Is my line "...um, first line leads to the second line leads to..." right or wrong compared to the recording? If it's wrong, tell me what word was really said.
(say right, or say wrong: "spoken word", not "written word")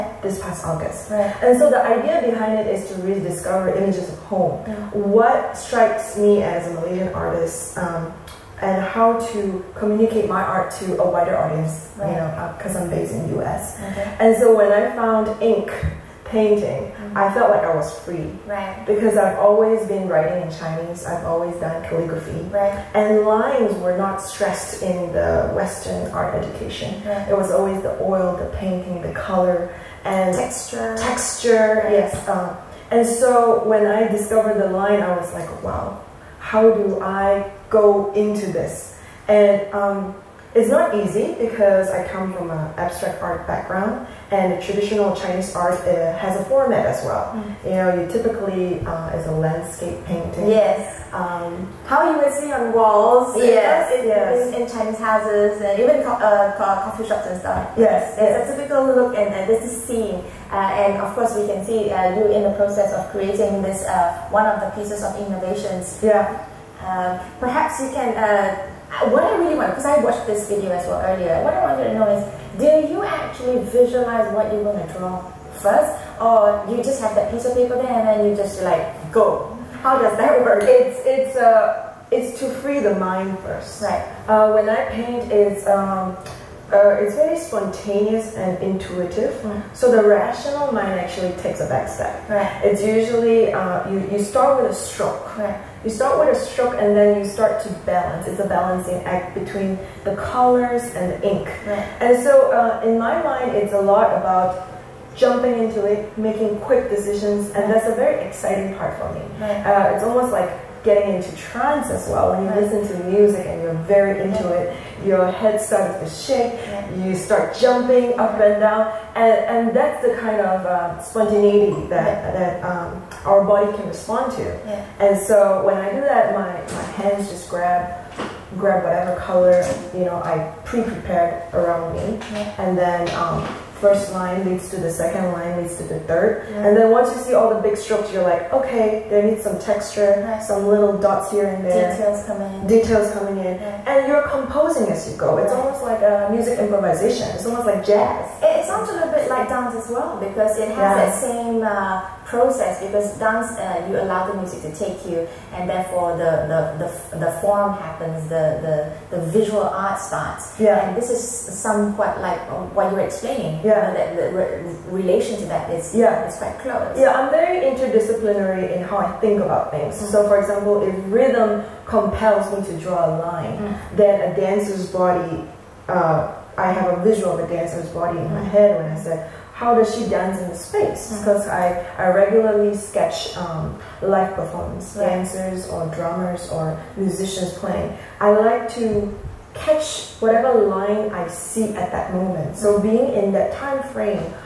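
right.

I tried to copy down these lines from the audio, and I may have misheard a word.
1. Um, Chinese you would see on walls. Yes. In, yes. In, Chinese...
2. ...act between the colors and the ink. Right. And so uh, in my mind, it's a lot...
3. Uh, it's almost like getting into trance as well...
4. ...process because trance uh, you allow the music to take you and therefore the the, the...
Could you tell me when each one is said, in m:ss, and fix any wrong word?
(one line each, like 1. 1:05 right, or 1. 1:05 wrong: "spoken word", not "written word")
1. 0:51 wrong: "How", not "Chinese"
2. 1:39 right
3. 1:49 right
4. 2:32 wrong: "dance", not "trance".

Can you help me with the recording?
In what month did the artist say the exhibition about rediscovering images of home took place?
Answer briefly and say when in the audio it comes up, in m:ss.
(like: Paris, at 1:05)
August, at 0:00.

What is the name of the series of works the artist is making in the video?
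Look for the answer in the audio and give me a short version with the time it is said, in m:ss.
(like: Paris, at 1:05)
Inknovations, at 1:05.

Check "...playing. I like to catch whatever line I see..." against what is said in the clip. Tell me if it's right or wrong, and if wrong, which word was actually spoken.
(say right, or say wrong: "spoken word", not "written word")
right.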